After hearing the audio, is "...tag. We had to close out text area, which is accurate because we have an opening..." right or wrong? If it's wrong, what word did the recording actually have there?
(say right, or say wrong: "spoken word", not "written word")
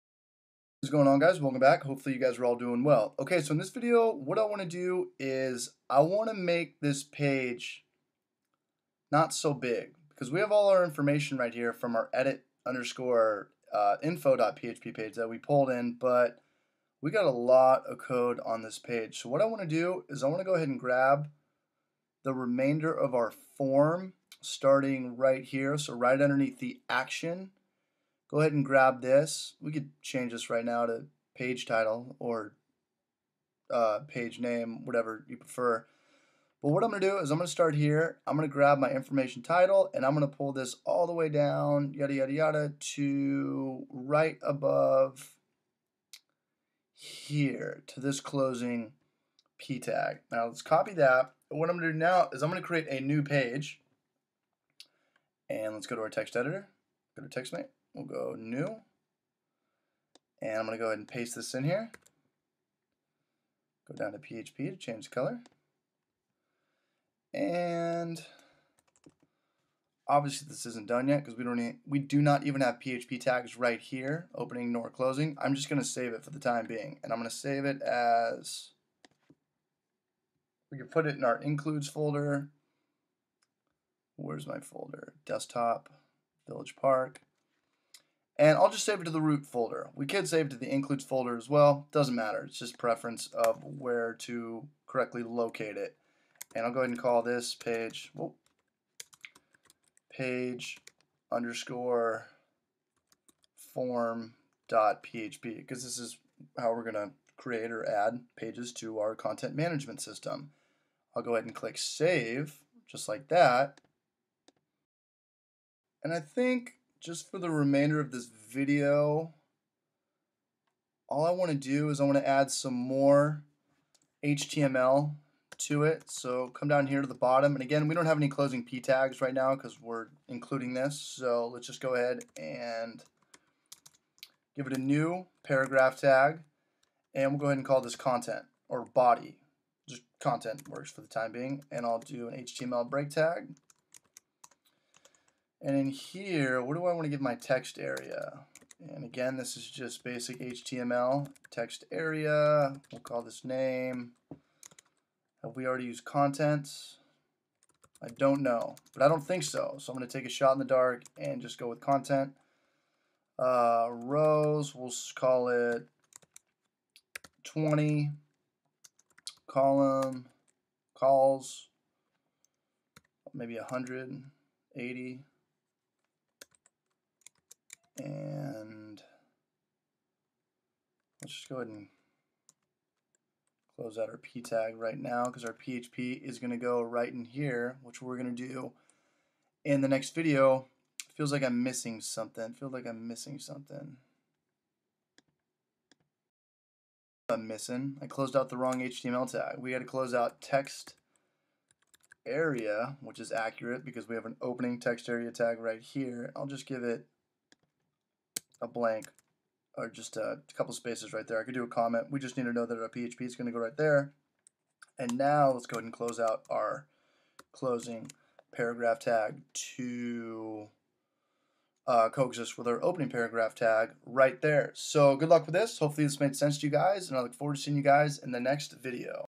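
right.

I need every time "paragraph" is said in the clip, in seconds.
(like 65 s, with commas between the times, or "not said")
135 s, 218 s, 223 s.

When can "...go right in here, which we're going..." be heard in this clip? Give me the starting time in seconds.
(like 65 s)
186 s.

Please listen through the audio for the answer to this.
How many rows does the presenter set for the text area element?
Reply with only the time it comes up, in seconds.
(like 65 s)
167 s.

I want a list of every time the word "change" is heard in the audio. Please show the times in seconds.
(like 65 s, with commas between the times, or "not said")
30 s, 64 s.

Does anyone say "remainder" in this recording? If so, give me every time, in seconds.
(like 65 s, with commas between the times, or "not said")
22 s, 117 s.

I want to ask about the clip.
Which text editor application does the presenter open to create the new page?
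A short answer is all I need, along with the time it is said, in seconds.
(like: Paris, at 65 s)
TextMate, at 57 s.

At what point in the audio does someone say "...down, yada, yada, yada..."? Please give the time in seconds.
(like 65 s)
41 s.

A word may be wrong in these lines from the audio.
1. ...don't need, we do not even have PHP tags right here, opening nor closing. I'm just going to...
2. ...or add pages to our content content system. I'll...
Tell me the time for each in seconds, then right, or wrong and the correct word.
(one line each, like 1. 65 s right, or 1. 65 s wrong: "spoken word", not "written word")
1. 71 s right
2. 107 s wrong: "management", not "content".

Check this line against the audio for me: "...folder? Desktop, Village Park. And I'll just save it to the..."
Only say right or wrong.
right.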